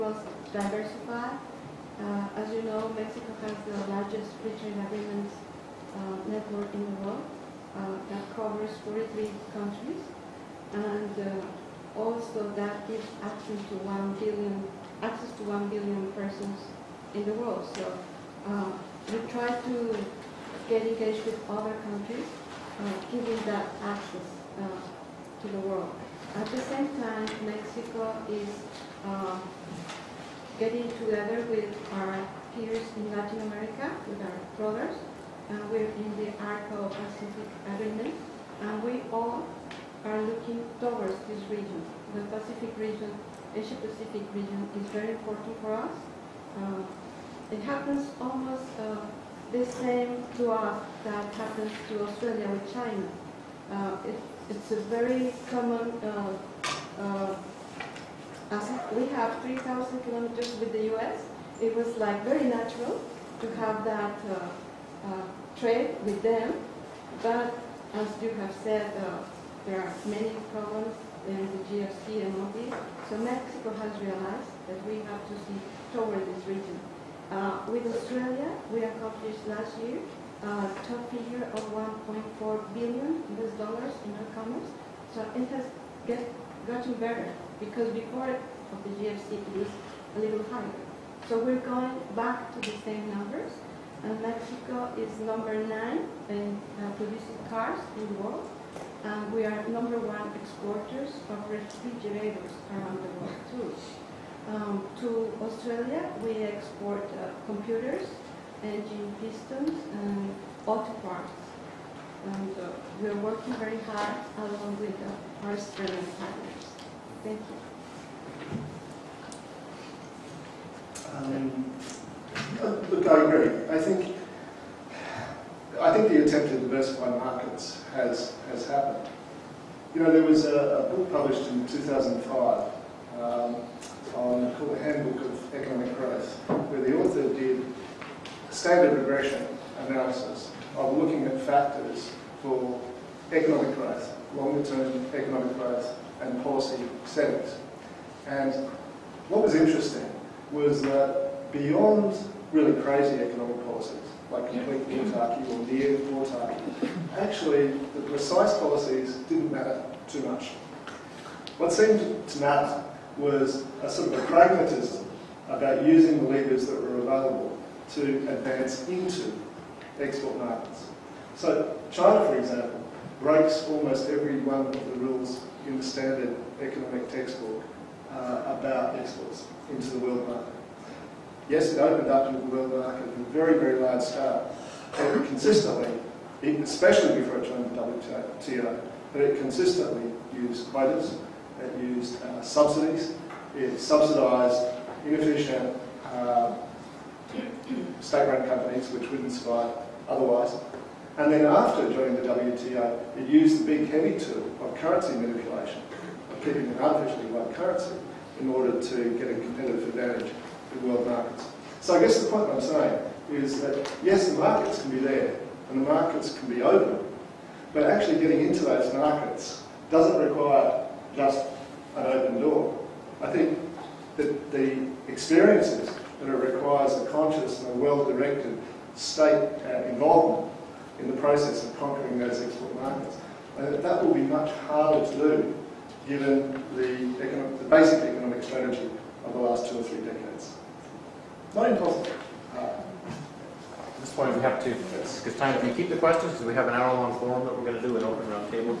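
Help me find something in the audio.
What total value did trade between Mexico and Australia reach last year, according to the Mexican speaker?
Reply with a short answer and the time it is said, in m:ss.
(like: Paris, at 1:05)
1.4 billion US dollars, at 1:21.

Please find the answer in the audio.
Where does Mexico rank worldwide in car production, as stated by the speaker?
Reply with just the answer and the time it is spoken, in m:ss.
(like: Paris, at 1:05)
Number nine, at 1:35.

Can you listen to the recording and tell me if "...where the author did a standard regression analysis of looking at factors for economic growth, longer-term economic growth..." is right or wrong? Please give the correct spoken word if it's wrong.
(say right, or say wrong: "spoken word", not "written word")
right.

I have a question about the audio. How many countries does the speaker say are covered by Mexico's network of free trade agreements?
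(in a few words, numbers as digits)
43.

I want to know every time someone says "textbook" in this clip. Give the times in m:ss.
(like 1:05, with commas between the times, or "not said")
2:57.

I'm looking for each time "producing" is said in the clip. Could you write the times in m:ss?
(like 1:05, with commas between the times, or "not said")
1:36.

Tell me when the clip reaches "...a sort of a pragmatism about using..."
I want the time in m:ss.
2:43.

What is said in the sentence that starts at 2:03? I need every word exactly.
I think I think the attempt to diversify markets has, has happened.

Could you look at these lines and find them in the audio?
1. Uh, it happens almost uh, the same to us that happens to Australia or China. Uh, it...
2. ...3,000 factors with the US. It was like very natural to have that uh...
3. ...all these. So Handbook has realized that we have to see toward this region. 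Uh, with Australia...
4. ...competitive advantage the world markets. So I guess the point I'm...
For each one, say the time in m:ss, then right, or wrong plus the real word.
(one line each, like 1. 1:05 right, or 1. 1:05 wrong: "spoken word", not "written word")
1. 0:46 right
2. 0:59 wrong: "kilometers", not "factors"
3. 1:12 wrong: "Mexico", not "Handbook"
4. 3:29 right.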